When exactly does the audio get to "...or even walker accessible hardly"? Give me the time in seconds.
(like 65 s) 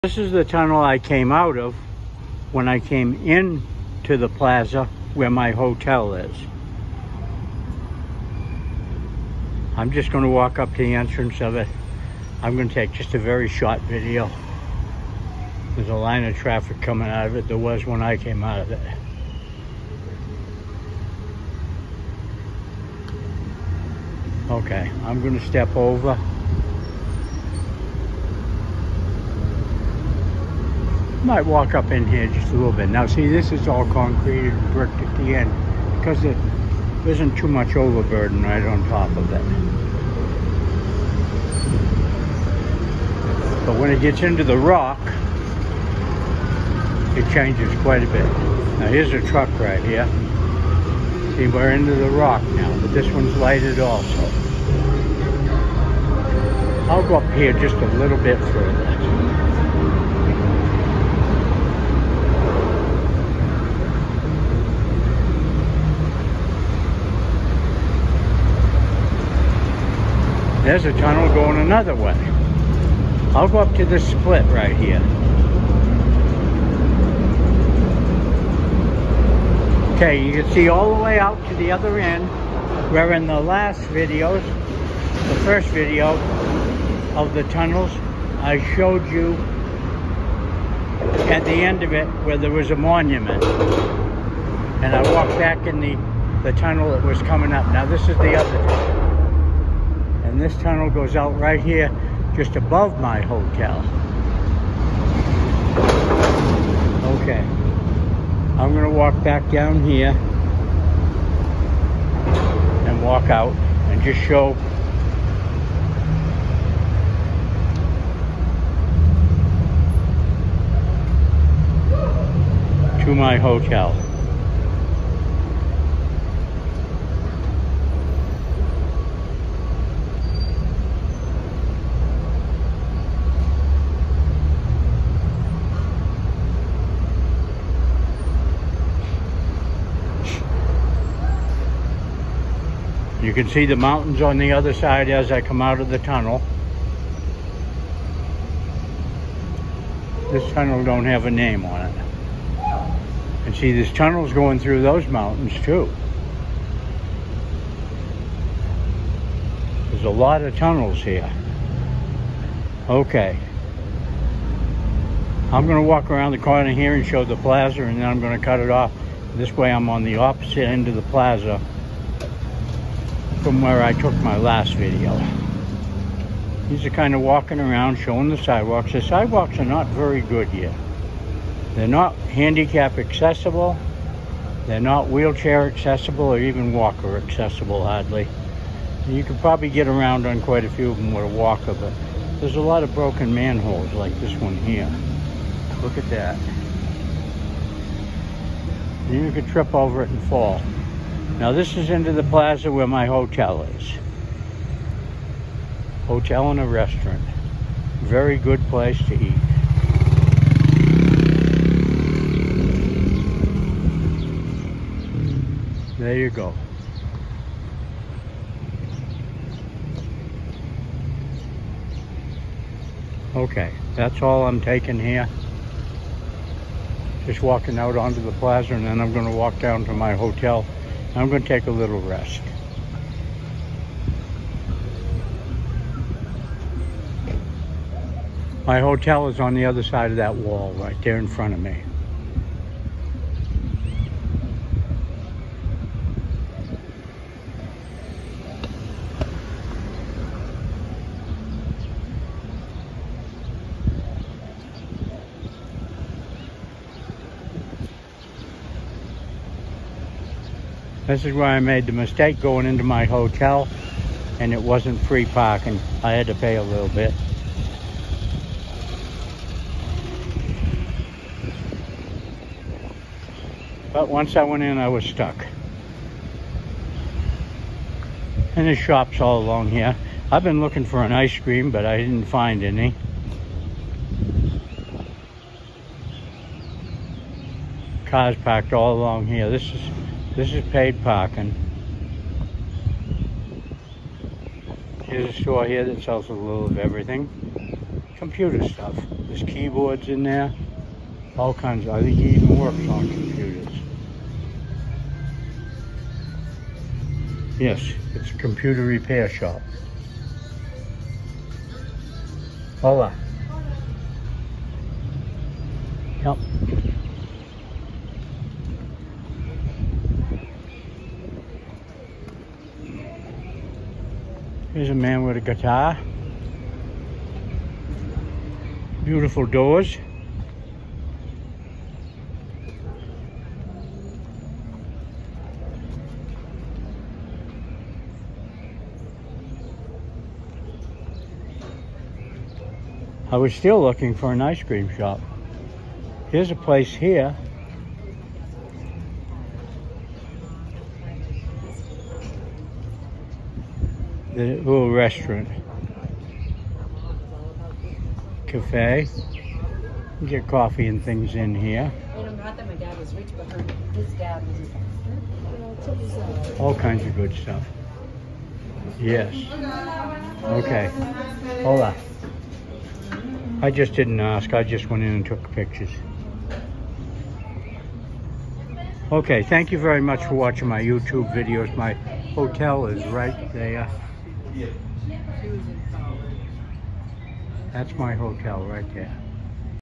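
186 s.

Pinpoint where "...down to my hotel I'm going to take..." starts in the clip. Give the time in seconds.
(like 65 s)
229 s.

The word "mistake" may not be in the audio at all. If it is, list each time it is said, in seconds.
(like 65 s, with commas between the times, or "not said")
261 s.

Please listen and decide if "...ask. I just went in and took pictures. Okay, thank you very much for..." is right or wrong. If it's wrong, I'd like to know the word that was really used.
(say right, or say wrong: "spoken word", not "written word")
right.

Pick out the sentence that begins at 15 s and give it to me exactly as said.
There's a line of traffic coming out of it.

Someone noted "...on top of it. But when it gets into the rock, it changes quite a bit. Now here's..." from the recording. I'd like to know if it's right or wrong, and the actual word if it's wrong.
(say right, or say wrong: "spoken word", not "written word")
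right.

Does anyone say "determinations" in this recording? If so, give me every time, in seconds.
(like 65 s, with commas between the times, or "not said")
not said.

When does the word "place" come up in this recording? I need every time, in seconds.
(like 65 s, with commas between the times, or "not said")
208 s, 346 s.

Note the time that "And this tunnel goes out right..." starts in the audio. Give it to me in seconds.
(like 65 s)
100 s.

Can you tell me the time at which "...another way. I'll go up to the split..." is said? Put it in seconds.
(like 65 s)
71 s.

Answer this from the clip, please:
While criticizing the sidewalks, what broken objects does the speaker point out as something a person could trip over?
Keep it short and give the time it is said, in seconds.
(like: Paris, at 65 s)
Manholes, at 193 s.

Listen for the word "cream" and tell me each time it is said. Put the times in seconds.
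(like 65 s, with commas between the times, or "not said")
281 s, 344 s.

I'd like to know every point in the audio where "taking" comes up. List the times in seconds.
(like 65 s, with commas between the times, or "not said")
224 s.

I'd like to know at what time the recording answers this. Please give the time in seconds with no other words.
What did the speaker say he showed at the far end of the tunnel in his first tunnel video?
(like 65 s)
92 s.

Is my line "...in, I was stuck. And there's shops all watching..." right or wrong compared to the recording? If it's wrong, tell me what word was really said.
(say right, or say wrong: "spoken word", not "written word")
wrong: "along", not "watching".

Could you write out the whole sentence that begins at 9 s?
I'm just going to walk up to the entrance of it.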